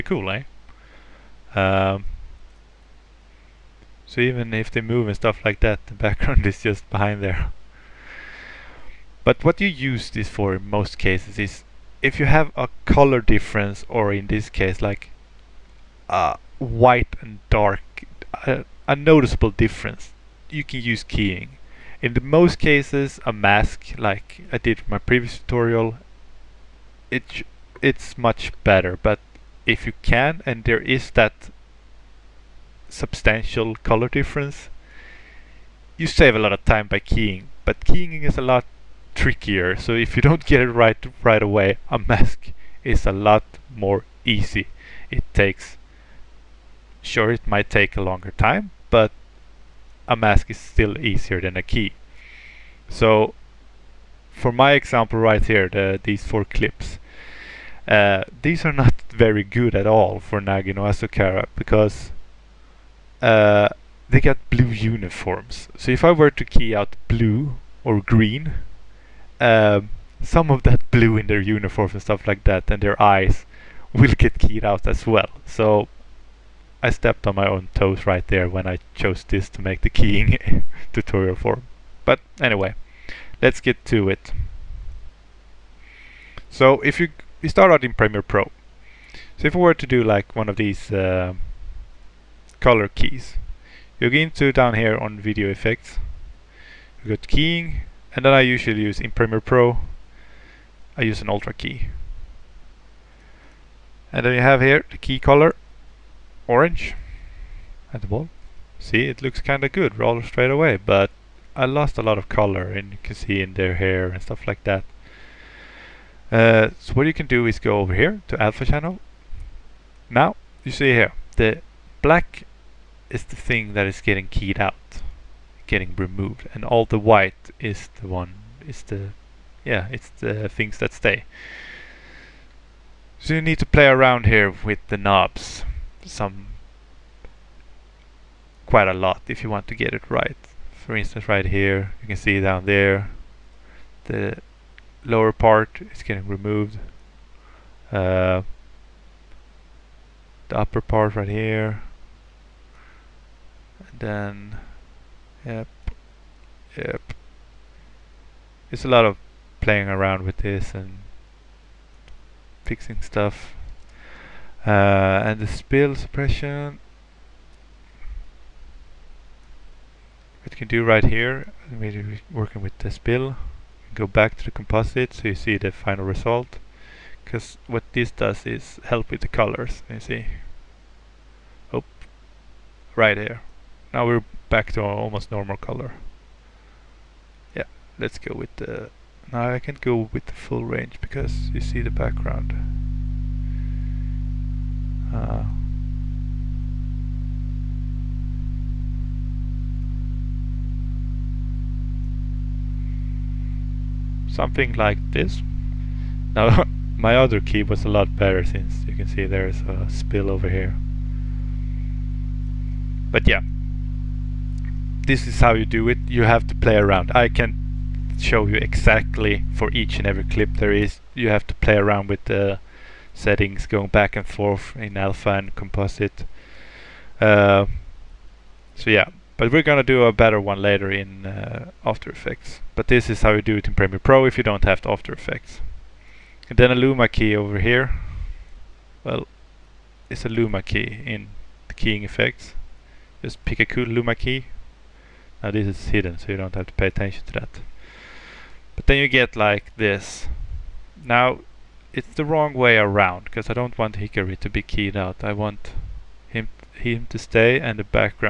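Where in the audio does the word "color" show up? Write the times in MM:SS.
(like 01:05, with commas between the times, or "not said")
00:12, 00:33, 01:32, 01:45, 01:52, 02:59, 03:05.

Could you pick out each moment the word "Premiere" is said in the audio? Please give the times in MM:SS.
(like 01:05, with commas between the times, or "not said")
01:27, 01:39, 03:53.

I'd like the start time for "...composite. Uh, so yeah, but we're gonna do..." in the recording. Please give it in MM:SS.
03:45.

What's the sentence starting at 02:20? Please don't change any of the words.
For instance right here you can see down there the lower part is getting removed.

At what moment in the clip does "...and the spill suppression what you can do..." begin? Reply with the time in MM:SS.
02:45.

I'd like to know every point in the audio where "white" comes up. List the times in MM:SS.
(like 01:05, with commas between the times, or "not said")
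00:16, 02:06.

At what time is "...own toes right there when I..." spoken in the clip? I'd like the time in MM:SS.
01:17.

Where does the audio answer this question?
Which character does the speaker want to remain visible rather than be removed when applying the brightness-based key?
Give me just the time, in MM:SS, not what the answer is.
04:13.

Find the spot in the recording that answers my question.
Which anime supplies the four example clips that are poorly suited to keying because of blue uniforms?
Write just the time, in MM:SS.
01:00.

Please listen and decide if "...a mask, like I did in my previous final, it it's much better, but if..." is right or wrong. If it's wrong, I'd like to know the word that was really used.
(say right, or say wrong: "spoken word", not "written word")
wrong: "tutorial", not "final".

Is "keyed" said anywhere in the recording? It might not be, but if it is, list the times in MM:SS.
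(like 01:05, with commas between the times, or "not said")
01:14, 02:04, 04:14.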